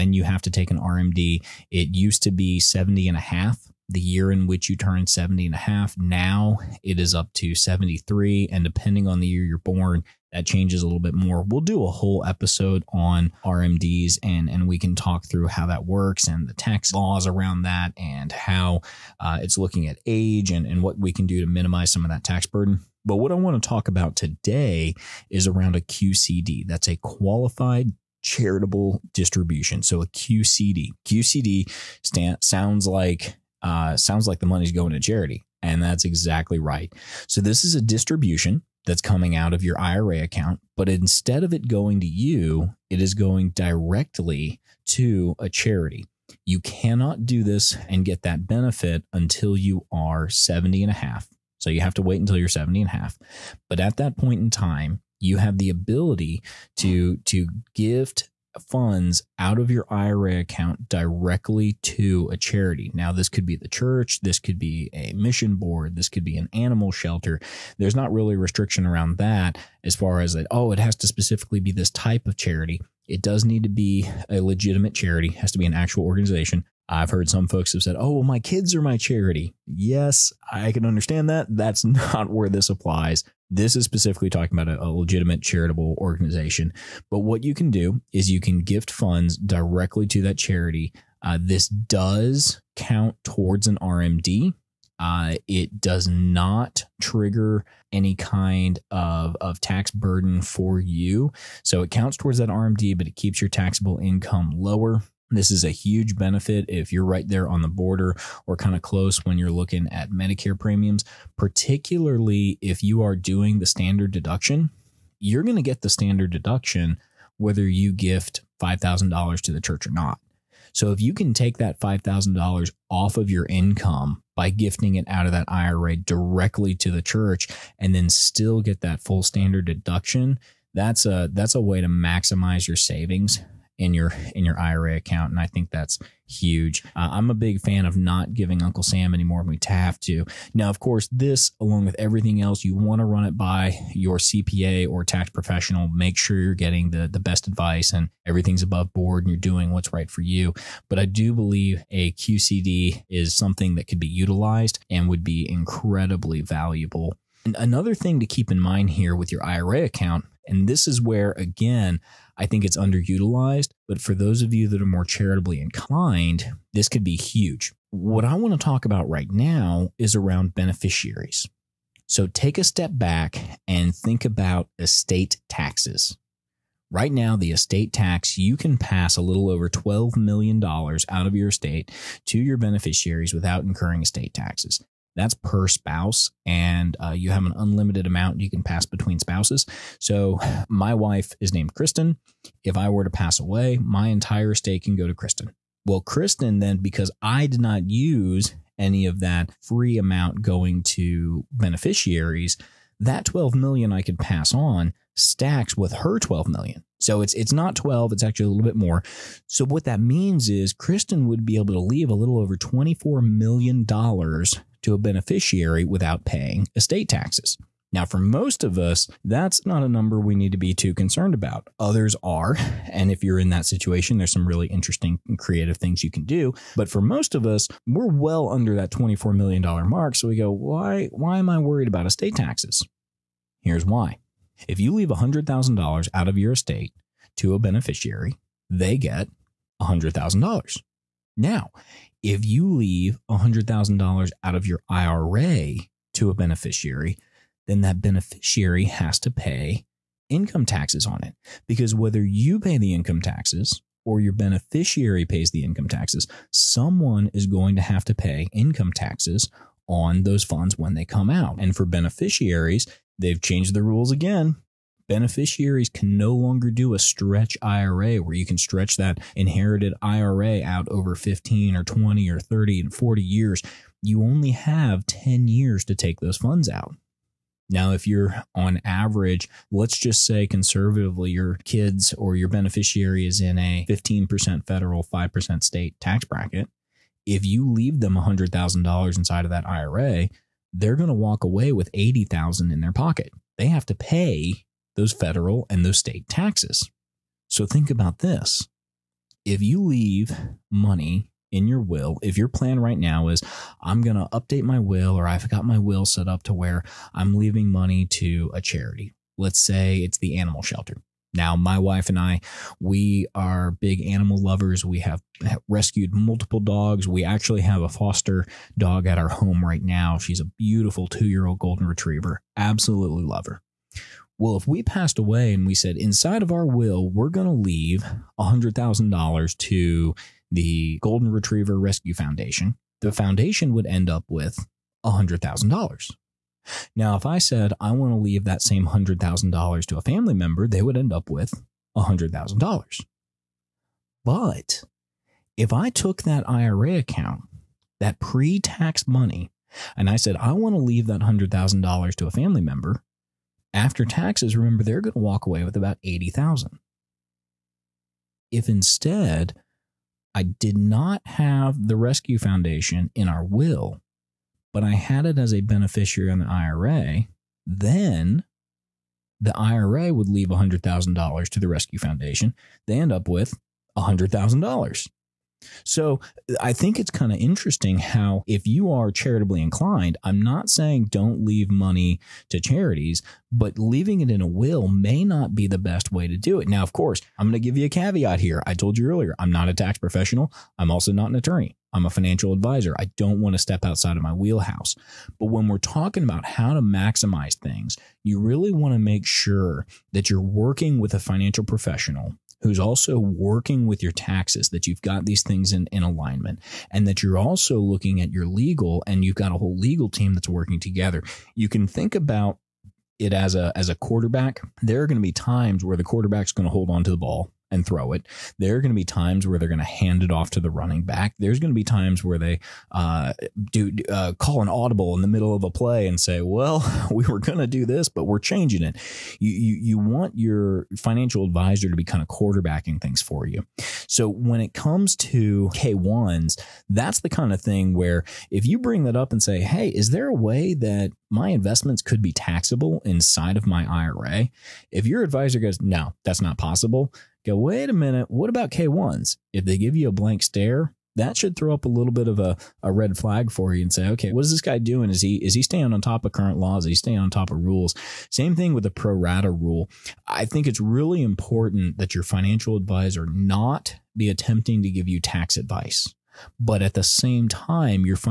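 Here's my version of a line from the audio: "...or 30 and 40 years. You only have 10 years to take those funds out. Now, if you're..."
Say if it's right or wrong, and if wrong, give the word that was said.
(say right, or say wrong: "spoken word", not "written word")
right.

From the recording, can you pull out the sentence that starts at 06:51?
You can think about it as a as a quarterback.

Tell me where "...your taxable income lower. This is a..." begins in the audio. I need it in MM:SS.
01:43.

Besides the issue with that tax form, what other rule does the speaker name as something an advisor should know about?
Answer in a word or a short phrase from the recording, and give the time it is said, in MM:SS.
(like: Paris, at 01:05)
Pro rata rule, at 07:38.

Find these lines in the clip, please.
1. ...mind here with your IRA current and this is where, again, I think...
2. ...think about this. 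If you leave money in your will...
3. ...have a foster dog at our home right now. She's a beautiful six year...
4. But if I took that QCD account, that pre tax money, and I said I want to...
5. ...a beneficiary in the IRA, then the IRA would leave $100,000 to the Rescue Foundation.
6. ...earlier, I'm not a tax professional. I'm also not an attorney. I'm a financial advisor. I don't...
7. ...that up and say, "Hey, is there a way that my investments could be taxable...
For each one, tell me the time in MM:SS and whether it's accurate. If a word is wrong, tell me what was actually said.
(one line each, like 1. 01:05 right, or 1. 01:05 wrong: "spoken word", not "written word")
1. 02:38 wrong: "account", not "current"
2. 04:57 right
3. 05:17 wrong: "two", not "six"
4. 05:44 wrong: "IRA", not "QCD"
5. 06:05 right
6. 06:29 right
7. 07:19 right.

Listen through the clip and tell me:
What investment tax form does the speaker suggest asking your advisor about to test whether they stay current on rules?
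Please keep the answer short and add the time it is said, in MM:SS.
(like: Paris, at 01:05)
K-1, at 07:28.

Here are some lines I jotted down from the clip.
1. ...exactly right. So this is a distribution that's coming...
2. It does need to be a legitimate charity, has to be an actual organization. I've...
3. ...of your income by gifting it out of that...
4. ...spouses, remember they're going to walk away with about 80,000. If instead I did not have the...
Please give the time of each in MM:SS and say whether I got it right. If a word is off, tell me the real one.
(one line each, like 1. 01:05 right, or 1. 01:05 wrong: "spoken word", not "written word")
1. 00:36 right
2. 01:13 right
3. 02:03 right
4. 05:54 wrong: "taxes", not "spouses".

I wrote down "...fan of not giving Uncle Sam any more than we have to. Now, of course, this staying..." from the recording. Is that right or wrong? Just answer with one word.
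wrong.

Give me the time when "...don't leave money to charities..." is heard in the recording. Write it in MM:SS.
06:21.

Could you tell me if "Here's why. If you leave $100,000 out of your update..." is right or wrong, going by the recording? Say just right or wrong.
wrong.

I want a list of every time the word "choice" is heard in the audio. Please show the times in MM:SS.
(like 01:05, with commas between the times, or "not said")
not said.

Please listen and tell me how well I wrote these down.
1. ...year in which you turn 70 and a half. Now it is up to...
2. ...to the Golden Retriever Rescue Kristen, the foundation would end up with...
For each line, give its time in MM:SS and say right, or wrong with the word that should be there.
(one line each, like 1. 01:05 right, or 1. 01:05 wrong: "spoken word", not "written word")
1. 00:04 right
2. 05:29 wrong: "Foundation", not "Kristen".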